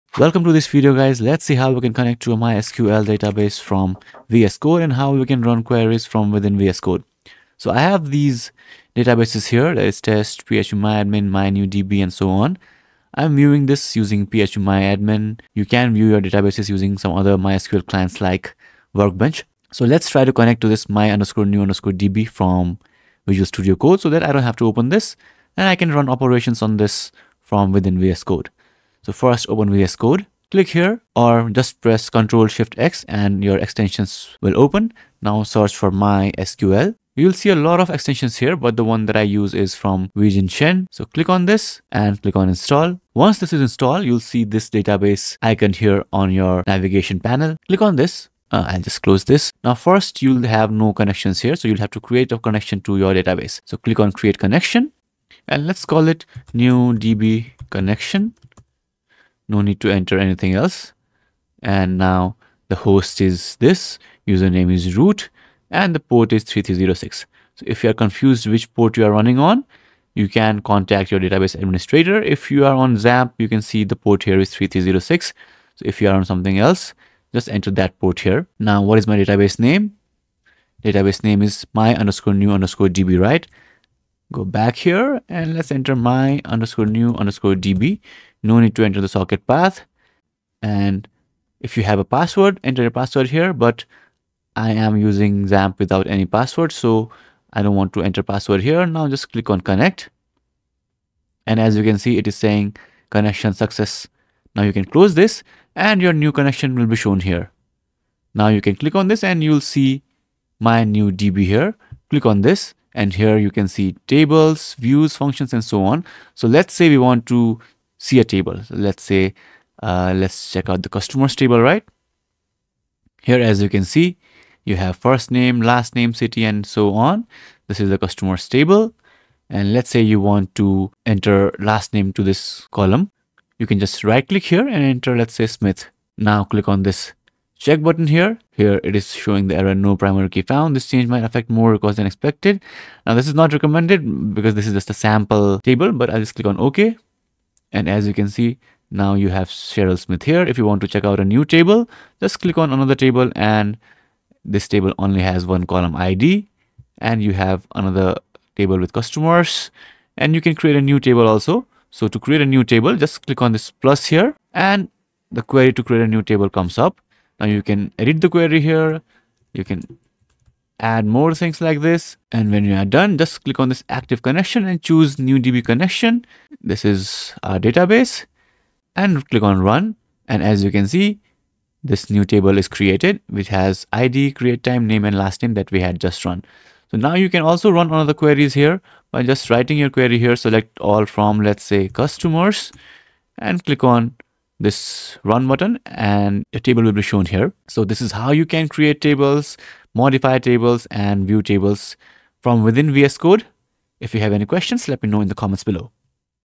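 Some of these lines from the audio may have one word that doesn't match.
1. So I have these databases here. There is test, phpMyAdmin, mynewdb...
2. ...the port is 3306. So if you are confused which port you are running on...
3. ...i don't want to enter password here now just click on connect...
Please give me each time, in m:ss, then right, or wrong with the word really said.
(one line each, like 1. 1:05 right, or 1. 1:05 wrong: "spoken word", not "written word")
1. 0:07 right
2. 1:05 right
3. 1:37 right.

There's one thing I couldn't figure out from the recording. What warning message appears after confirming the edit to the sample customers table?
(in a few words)
No primary key found.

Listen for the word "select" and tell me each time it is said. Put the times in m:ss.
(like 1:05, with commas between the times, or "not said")
3:10.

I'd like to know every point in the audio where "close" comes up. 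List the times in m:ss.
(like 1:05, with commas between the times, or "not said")
0:49, 1:44.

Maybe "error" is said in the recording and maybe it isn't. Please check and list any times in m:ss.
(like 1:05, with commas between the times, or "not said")
2:19.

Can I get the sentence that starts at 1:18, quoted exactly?
Now, what is my database name?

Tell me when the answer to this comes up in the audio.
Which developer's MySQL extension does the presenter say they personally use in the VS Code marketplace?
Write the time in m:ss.
0:40.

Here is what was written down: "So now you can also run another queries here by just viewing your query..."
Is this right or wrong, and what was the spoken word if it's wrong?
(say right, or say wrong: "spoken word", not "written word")
wrong: "writing", not "viewing".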